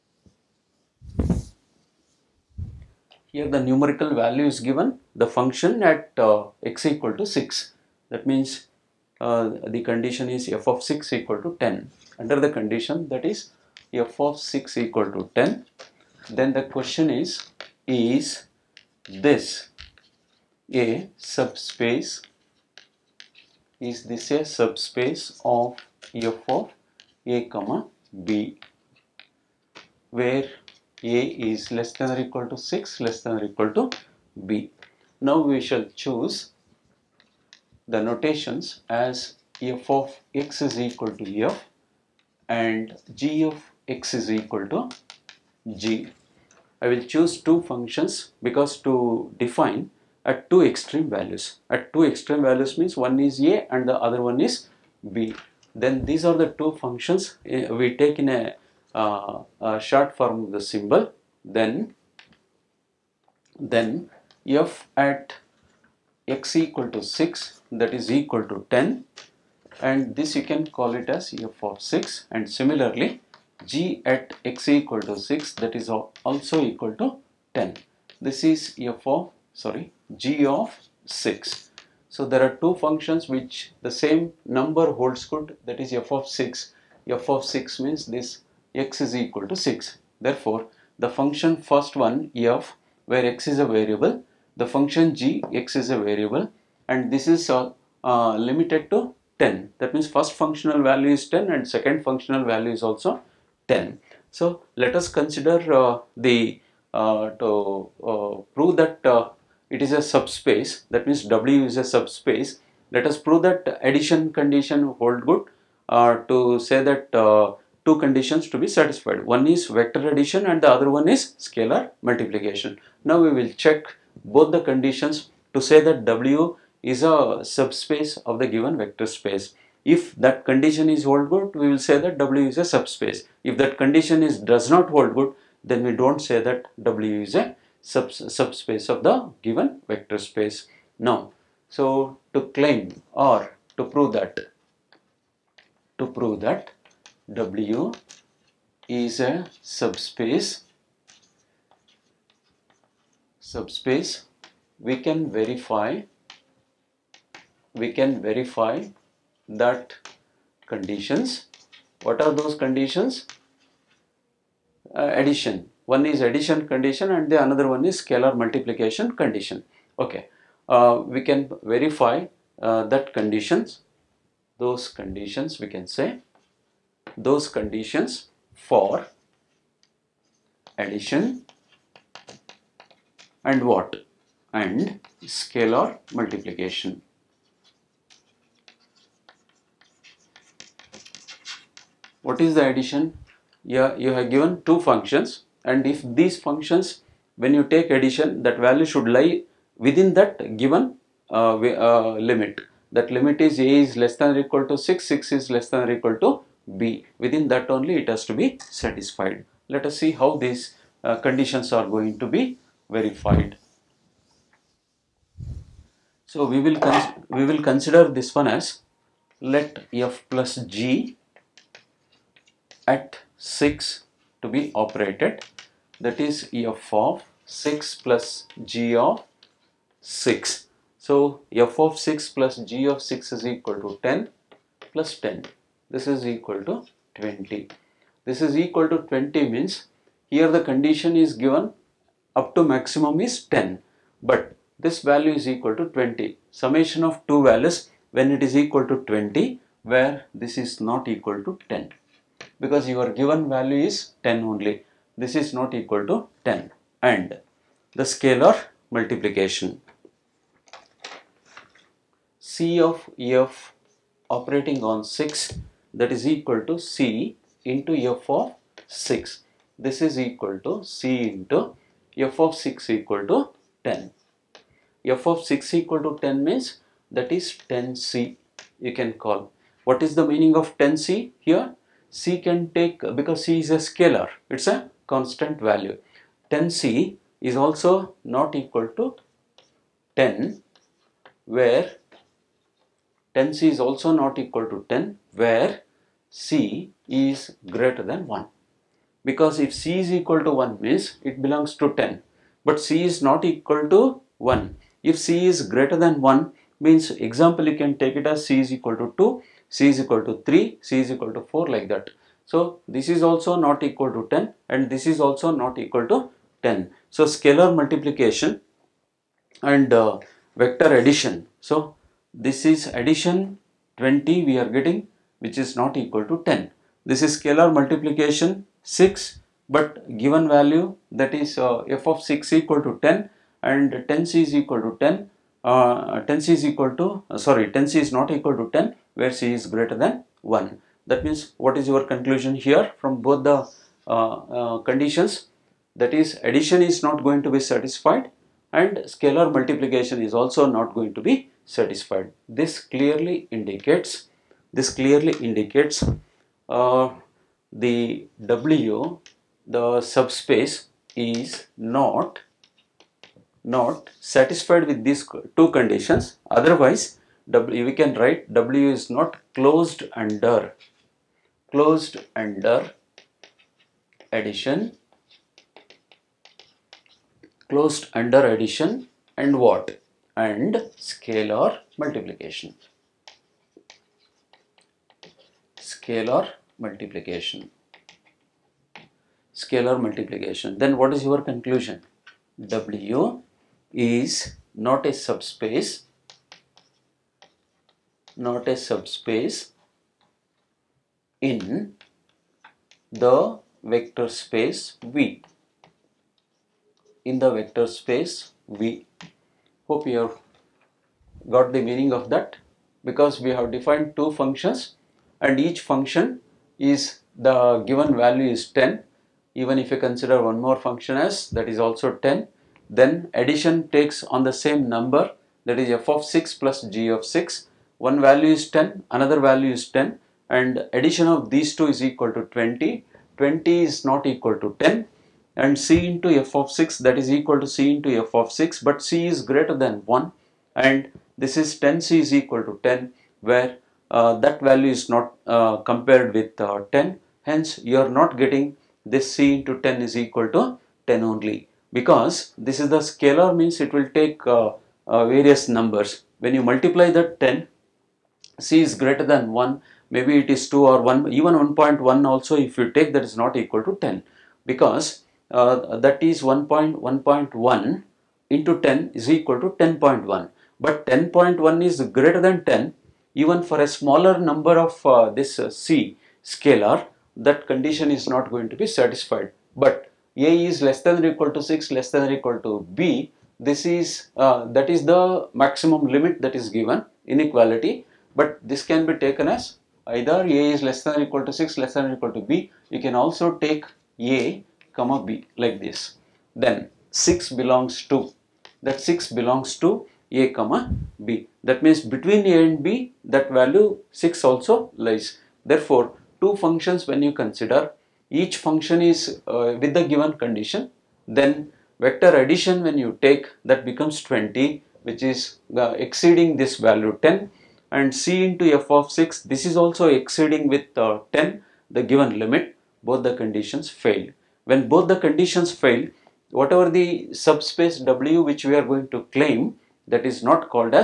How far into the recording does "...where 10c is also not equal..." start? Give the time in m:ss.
4:51.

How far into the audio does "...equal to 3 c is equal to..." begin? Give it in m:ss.
5:10.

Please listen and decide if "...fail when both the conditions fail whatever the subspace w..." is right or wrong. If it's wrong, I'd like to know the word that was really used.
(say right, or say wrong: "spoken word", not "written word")
right.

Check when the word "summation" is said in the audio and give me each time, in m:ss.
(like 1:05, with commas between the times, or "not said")
4:06.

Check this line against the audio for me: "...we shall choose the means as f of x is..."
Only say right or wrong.
wrong.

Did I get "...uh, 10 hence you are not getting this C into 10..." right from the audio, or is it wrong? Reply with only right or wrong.
right.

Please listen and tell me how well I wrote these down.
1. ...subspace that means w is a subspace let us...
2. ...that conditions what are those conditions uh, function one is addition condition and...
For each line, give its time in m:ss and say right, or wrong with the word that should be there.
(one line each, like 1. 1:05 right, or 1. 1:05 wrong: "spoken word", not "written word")
1. 1:50 right
2. 2:39 wrong: "addition", not "function".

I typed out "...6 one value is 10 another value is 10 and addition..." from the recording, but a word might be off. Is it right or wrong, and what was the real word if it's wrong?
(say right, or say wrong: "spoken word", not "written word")
right.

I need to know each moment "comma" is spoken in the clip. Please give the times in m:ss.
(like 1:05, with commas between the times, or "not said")
0:27, 8:14, 8:20.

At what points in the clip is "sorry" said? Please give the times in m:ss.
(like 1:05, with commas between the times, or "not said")
1:19, 5:37.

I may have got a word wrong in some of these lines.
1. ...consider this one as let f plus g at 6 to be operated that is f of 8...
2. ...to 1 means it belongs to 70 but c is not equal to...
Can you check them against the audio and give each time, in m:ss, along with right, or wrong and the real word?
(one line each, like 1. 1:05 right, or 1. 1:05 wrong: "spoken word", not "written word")
1. 3:37 wrong: "6", not "8"
2. 5:00 wrong: "10", not "70".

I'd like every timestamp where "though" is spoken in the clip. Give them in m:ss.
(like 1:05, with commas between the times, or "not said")
not said.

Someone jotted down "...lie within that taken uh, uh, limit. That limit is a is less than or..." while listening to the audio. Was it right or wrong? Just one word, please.
wrong.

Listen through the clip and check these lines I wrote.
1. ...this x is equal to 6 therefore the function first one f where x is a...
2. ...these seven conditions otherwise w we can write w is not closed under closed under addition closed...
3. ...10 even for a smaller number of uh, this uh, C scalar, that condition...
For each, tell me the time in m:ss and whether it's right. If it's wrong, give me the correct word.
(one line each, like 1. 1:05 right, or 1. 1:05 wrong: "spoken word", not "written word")
1. 1:28 right
2. 6:05 wrong: "two", not "seven"
3. 7:52 right.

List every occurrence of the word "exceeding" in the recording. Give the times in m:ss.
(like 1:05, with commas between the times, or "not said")
8:36, 8:40.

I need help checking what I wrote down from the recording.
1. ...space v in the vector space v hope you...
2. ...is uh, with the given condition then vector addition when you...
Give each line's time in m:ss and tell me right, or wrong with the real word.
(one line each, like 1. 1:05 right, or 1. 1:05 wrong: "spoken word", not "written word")
1. 6:44 right
2. 8:29 right.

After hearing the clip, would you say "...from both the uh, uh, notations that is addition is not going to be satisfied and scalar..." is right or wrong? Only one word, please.
wrong.